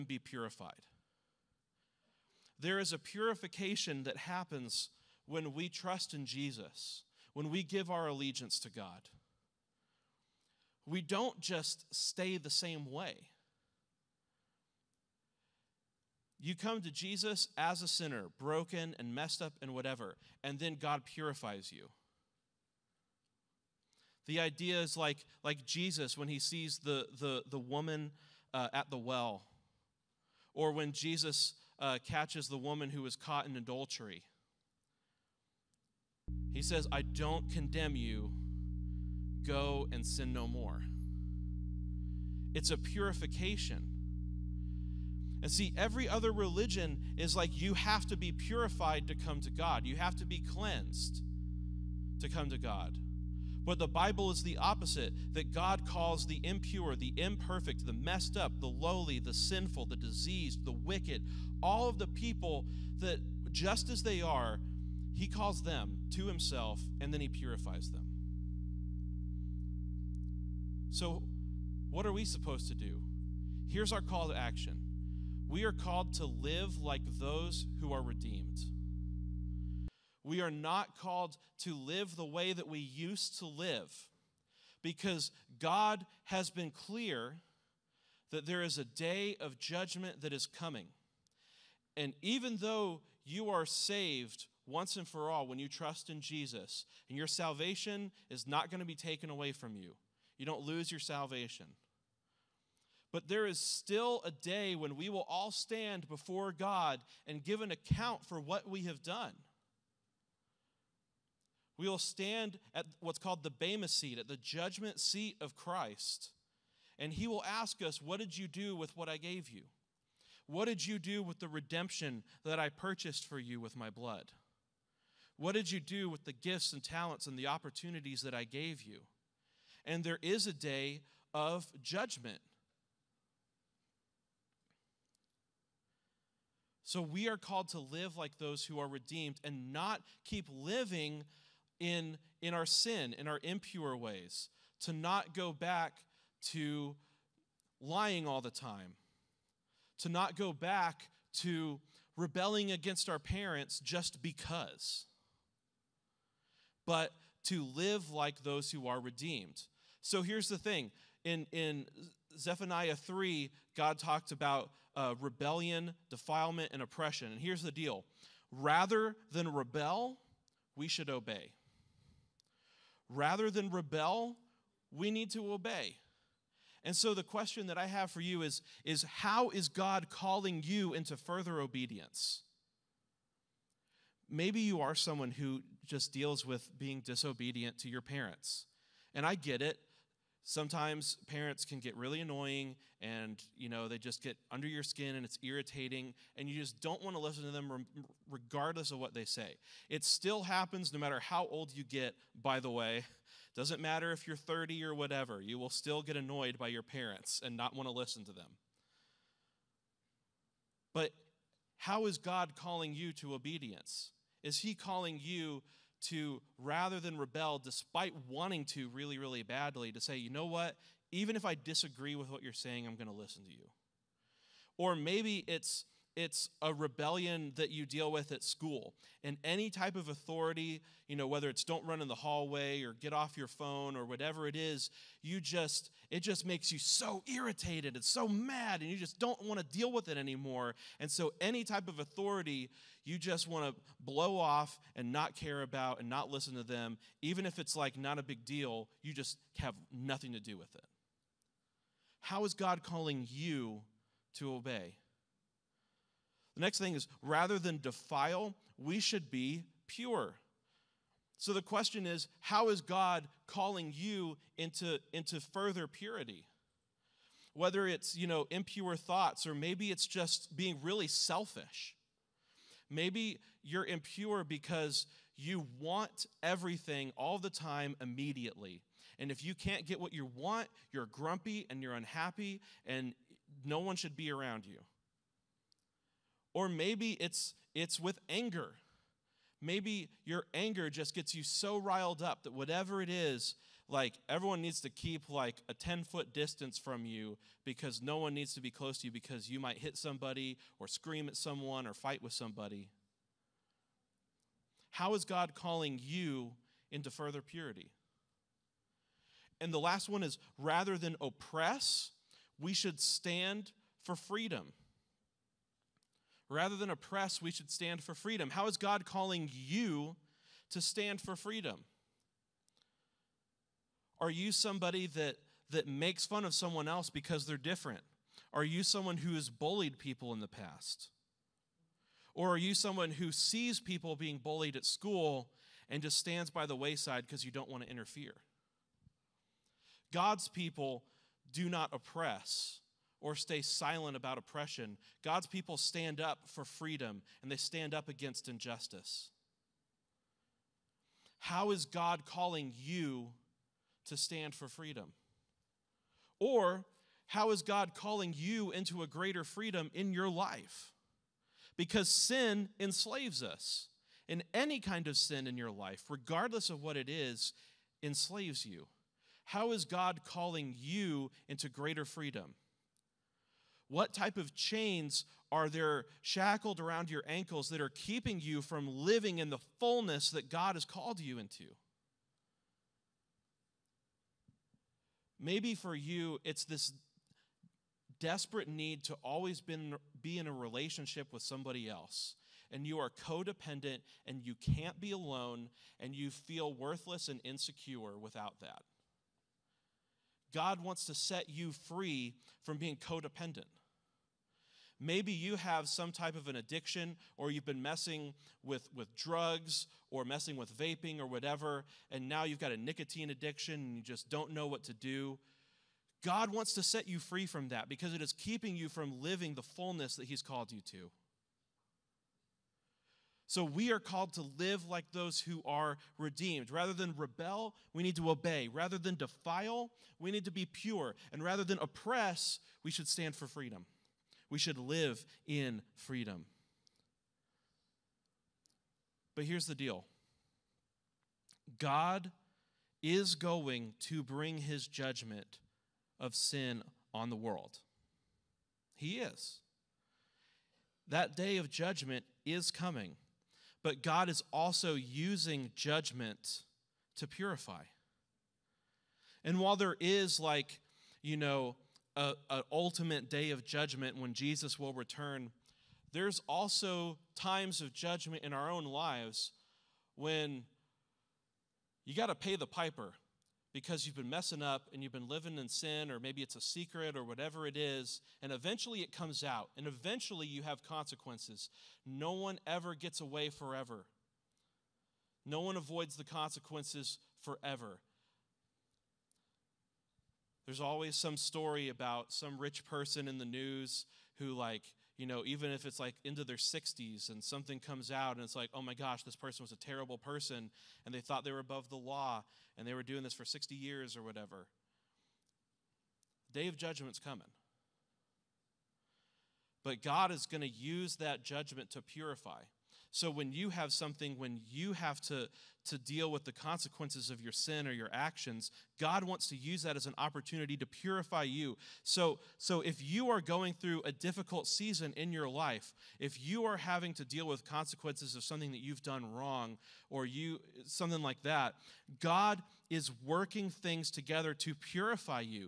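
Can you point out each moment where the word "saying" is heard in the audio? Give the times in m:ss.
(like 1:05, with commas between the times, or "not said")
3:42.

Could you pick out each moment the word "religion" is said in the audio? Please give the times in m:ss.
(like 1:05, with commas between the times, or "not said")
0:46.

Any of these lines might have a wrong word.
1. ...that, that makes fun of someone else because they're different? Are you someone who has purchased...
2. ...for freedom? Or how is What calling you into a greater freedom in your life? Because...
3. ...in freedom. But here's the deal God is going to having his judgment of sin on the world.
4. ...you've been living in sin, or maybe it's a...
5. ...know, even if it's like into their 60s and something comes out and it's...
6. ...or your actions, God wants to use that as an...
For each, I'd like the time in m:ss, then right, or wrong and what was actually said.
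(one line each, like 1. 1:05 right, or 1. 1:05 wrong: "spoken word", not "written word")
1. 5:25 wrong: "bullied", not "purchased"
2. 5:54 wrong: "God", not "What"
3. 7:15 wrong: "bring", not "having"
4. 7:55 right
5. 8:15 right
6. 8:37 right.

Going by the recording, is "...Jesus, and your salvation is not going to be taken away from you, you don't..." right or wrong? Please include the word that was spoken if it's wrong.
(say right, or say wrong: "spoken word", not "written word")
right.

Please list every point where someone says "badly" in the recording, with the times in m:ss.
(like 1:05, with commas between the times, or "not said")
3:39.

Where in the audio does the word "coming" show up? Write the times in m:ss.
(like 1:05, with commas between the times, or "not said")
1:30, 7:32, 8:27.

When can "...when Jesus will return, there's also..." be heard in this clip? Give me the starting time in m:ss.
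7:44.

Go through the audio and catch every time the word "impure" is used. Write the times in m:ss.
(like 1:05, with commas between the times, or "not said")
0:56, 2:23, 4:28, 4:33.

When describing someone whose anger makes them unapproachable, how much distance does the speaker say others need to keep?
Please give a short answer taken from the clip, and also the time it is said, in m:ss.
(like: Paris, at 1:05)
10 foot, at 4:55.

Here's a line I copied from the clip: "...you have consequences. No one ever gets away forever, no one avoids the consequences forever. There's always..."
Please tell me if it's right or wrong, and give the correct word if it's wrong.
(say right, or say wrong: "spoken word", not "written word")
right.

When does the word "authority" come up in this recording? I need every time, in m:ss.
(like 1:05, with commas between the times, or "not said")
3:50, 4:01.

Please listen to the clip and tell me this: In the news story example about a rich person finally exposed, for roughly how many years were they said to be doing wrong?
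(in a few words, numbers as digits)
60.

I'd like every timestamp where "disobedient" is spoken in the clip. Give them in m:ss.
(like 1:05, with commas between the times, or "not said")
3:06.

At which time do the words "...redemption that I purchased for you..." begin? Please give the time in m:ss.
2:01.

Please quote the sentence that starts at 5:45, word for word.
God's people stand up for freedom and they stand up against injustice.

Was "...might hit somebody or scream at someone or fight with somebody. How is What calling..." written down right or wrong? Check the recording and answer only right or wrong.
wrong.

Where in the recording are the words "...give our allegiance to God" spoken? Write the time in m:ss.
0:07.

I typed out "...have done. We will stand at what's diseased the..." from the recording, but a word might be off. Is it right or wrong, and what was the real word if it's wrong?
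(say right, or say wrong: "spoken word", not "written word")
wrong: "called", not "diseased".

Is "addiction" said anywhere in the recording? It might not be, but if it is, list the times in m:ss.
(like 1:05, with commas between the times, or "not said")
6:46, 6:53.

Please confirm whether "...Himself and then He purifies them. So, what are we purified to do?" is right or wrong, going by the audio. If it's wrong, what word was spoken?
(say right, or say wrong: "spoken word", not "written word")
wrong: "supposed", not "purified".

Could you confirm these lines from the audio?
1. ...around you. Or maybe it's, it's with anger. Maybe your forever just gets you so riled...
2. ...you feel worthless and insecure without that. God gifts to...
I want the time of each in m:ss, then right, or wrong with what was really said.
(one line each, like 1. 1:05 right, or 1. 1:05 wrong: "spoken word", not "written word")
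1. 4:44 wrong: "anger", not "forever"
2. 6:36 wrong: "wants", not "gifts".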